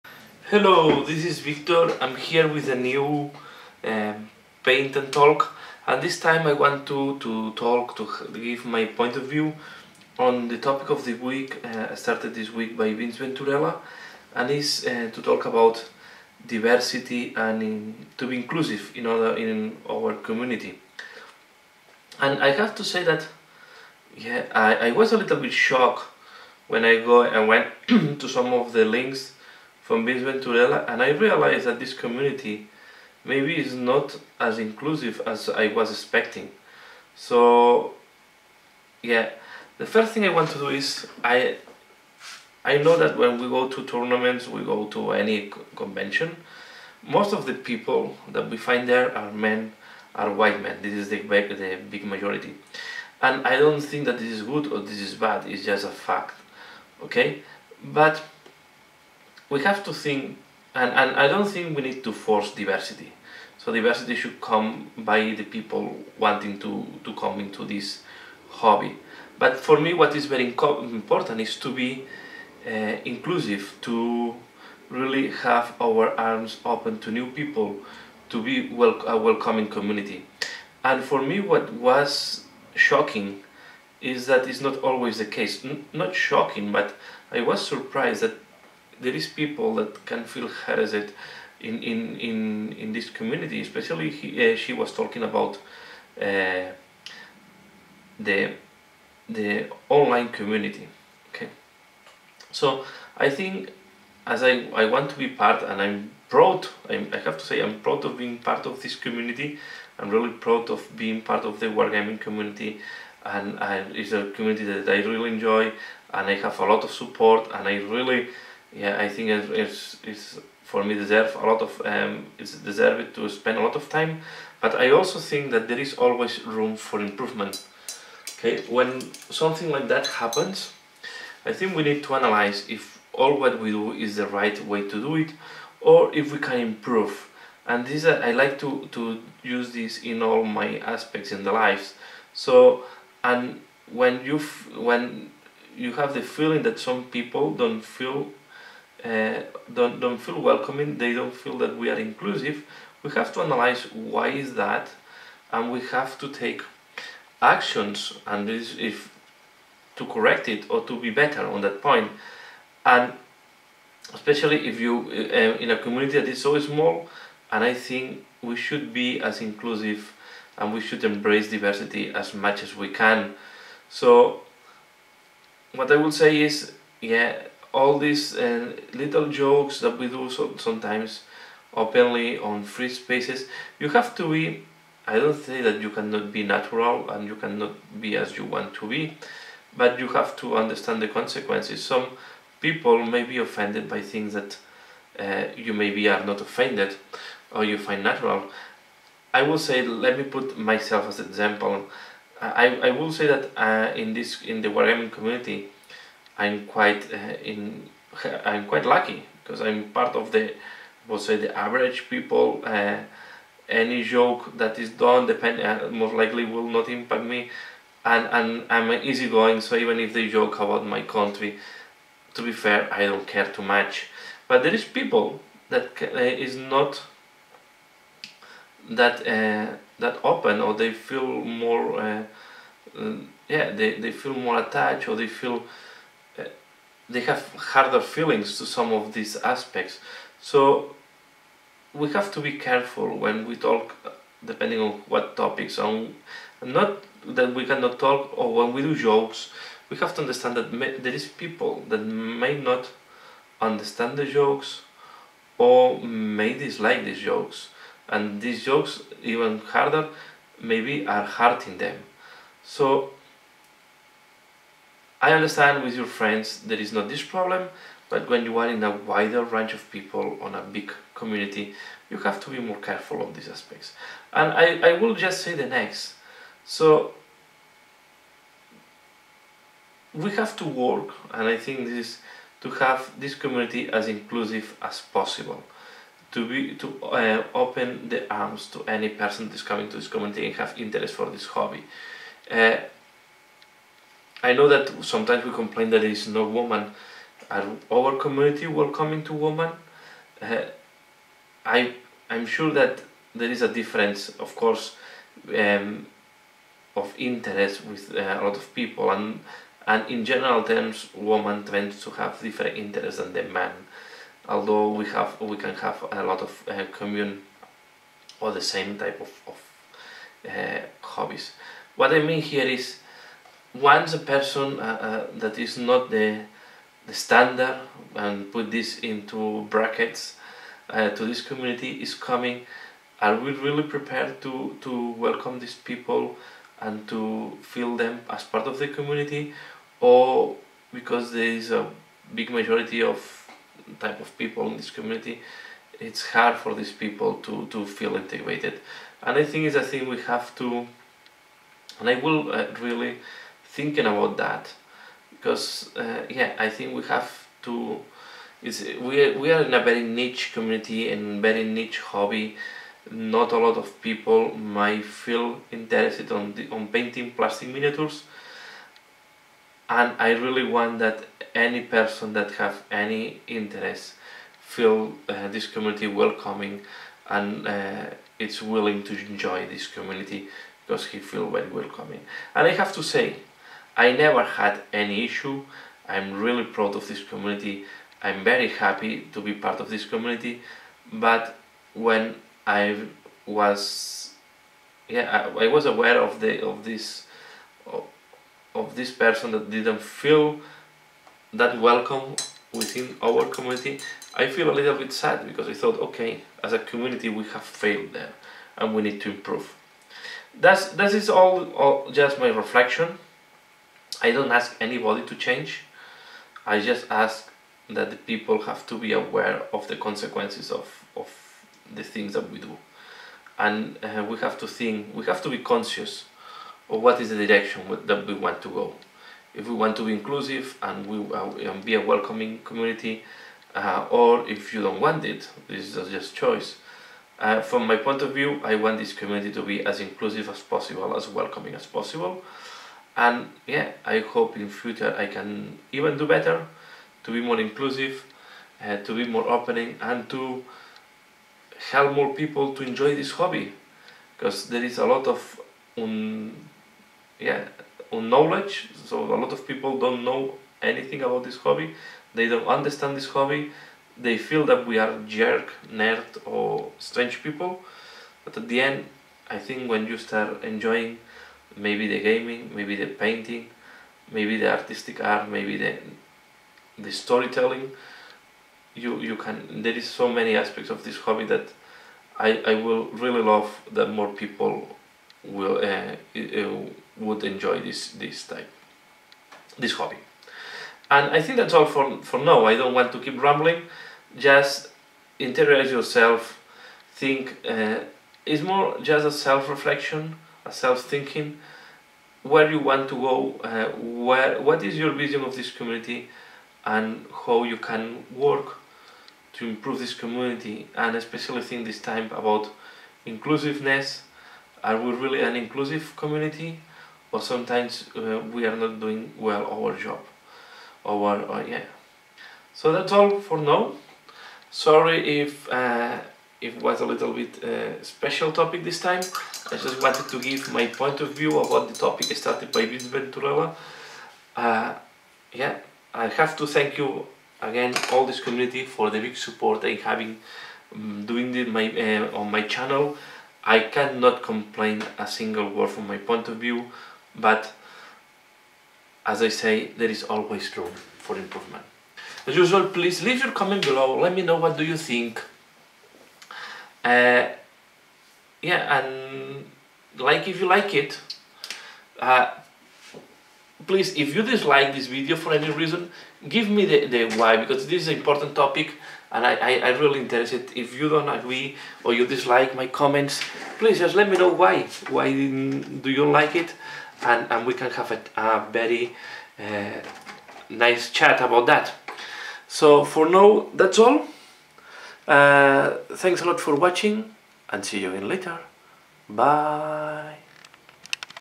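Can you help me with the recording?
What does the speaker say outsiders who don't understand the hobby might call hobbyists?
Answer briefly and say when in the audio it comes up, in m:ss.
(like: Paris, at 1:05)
jerk nerd, at 7:45.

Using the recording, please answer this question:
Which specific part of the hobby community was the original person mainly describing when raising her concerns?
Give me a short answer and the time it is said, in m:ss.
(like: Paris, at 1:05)
the online community, at 1:39.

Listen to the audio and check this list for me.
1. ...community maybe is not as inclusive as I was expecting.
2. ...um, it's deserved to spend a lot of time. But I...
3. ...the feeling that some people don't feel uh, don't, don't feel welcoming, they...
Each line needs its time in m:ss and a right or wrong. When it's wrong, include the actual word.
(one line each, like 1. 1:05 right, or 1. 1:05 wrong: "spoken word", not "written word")
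1. 0:31 right
2. 2:01 right
3. 2:26 right.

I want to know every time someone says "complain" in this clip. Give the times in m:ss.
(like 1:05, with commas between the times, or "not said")
4:55, 9:04.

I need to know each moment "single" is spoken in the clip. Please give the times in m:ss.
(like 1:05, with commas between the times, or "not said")
9:05.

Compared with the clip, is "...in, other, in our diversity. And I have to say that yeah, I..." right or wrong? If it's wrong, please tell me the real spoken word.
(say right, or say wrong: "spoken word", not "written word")
wrong: "community", not "diversity".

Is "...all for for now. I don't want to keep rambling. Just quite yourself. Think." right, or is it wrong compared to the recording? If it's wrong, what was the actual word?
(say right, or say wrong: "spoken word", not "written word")
wrong: "interrogate", not "quite".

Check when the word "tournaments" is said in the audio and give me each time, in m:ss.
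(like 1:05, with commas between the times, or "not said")
0:43.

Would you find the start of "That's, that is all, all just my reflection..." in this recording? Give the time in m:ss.
6:50.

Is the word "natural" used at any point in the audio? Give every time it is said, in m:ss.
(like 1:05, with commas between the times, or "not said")
3:06, 3:18.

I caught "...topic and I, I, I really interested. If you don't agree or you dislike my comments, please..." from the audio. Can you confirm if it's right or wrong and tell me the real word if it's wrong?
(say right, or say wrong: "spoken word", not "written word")
right.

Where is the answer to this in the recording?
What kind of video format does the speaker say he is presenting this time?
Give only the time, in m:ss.
0:04.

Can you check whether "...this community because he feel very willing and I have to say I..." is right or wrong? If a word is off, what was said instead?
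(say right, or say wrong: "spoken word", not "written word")
wrong: "welcoming", not "willing".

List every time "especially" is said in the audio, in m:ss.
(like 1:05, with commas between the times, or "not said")
1:33, 2:44, 8:31.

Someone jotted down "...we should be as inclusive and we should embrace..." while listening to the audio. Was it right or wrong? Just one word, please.
right.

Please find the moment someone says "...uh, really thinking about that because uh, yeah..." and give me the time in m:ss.
5:52.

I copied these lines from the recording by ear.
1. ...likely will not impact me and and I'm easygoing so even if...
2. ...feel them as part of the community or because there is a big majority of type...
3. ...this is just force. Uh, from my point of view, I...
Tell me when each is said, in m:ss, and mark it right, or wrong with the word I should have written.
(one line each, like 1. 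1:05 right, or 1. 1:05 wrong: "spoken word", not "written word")
1. 3:36 right
2. 5:37 right
3. 7:15 wrong: "choice", not "force".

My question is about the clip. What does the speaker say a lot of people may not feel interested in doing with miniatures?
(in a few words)
painting plastic miniatures.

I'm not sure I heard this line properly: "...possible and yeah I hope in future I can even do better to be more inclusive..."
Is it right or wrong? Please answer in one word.
right.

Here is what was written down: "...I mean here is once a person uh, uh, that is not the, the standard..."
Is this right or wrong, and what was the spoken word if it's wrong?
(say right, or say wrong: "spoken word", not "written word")
right.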